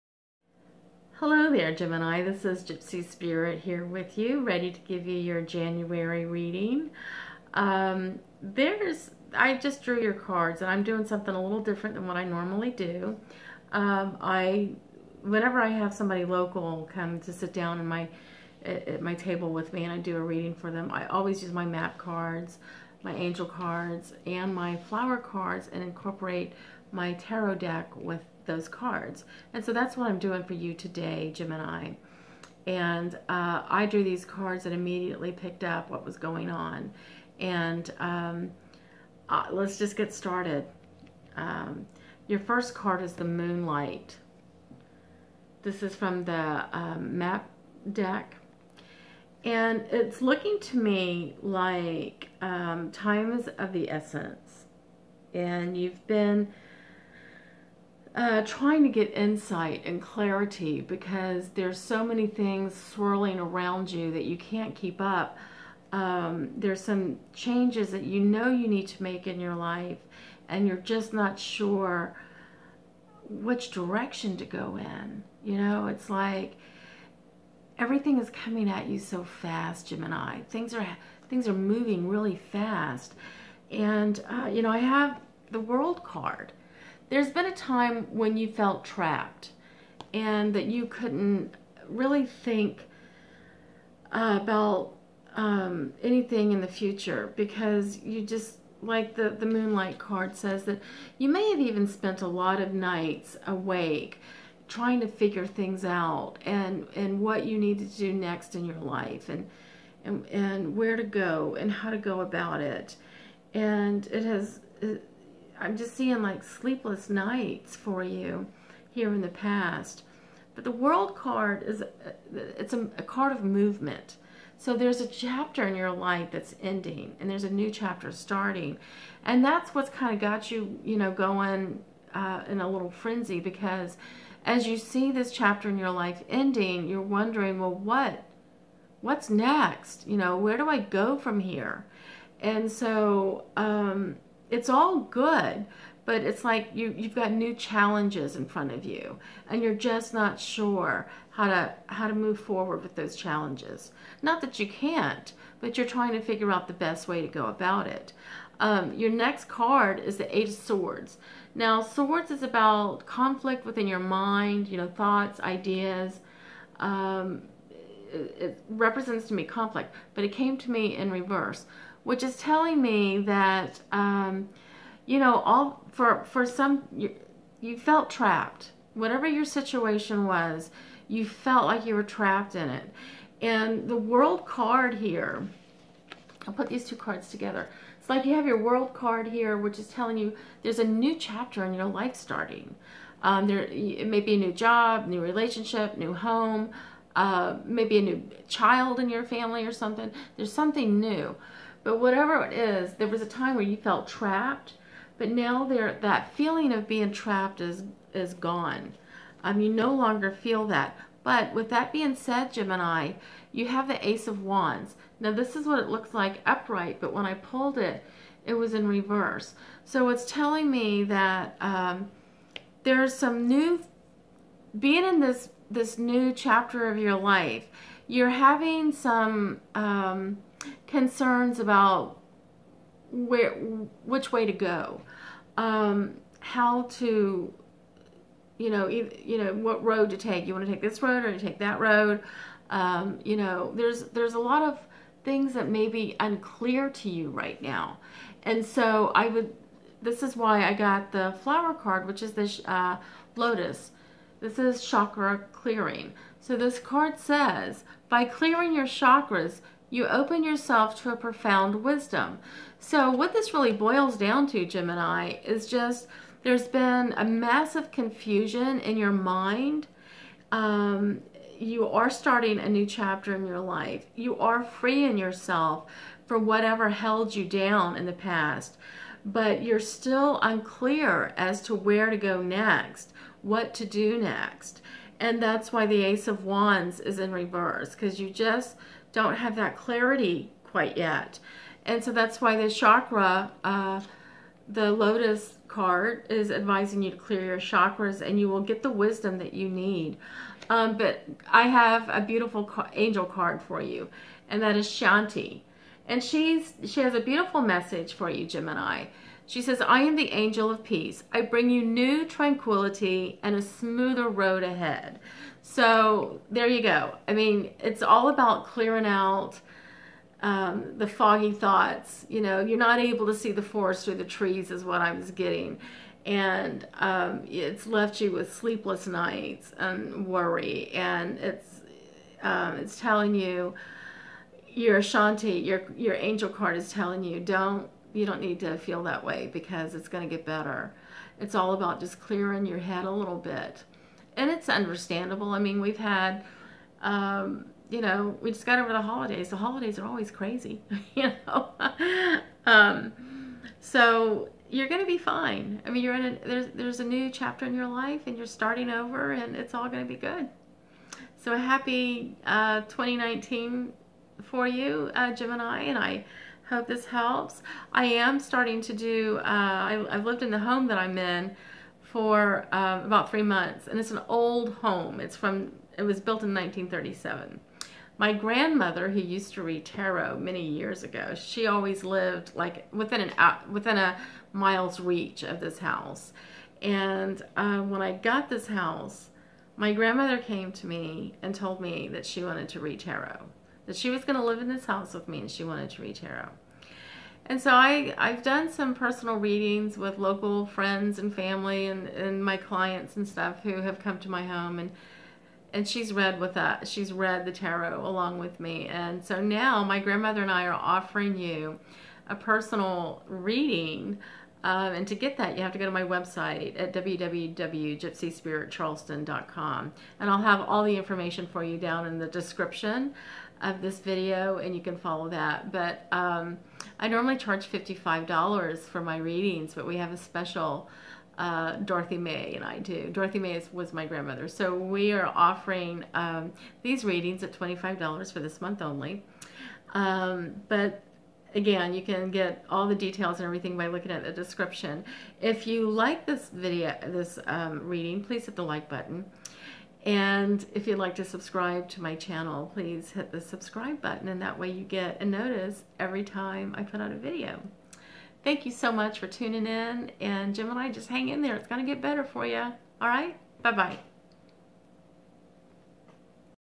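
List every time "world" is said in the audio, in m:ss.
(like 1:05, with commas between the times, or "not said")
1:25, 2:00, 3:03, 3:08.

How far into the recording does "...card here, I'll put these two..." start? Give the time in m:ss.
3:04.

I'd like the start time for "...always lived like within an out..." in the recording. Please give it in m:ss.
6:21.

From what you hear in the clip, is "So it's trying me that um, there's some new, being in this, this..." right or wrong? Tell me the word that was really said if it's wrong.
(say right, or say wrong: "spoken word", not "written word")
wrong: "telling", not "trying".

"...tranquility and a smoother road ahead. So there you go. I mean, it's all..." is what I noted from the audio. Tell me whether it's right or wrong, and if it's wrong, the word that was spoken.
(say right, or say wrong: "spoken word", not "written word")
right.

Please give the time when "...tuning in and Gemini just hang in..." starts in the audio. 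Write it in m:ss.
7:39.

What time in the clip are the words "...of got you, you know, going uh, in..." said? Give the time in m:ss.
2:10.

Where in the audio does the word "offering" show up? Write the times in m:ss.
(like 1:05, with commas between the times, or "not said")
6:50, 7:15.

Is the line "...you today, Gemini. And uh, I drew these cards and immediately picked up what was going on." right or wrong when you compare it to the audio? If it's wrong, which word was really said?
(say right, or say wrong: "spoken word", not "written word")
right.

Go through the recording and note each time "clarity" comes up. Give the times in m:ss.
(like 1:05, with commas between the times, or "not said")
1:00, 4:49.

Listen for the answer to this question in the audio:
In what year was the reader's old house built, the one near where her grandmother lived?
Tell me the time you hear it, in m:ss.
6:16.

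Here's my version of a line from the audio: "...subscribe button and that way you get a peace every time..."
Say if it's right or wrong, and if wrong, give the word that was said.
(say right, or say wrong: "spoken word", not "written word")
wrong: "notice", not "peace".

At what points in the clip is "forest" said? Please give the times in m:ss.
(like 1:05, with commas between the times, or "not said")
5:23.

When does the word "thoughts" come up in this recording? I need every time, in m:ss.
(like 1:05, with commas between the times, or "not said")
2:44, 5:21.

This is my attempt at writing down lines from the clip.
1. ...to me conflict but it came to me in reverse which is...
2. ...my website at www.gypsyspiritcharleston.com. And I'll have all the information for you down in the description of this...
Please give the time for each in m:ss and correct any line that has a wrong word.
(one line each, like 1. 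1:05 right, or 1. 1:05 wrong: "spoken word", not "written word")
1. 2:49 right
2. 6:55 right.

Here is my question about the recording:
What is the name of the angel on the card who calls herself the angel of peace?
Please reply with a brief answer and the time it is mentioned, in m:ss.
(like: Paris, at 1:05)
Shanti, at 5:04.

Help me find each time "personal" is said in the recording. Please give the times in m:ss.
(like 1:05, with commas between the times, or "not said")
6:38, 6:52.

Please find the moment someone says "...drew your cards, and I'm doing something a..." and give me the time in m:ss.
0:09.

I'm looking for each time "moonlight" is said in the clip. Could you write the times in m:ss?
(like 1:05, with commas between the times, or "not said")
0:43, 1:39.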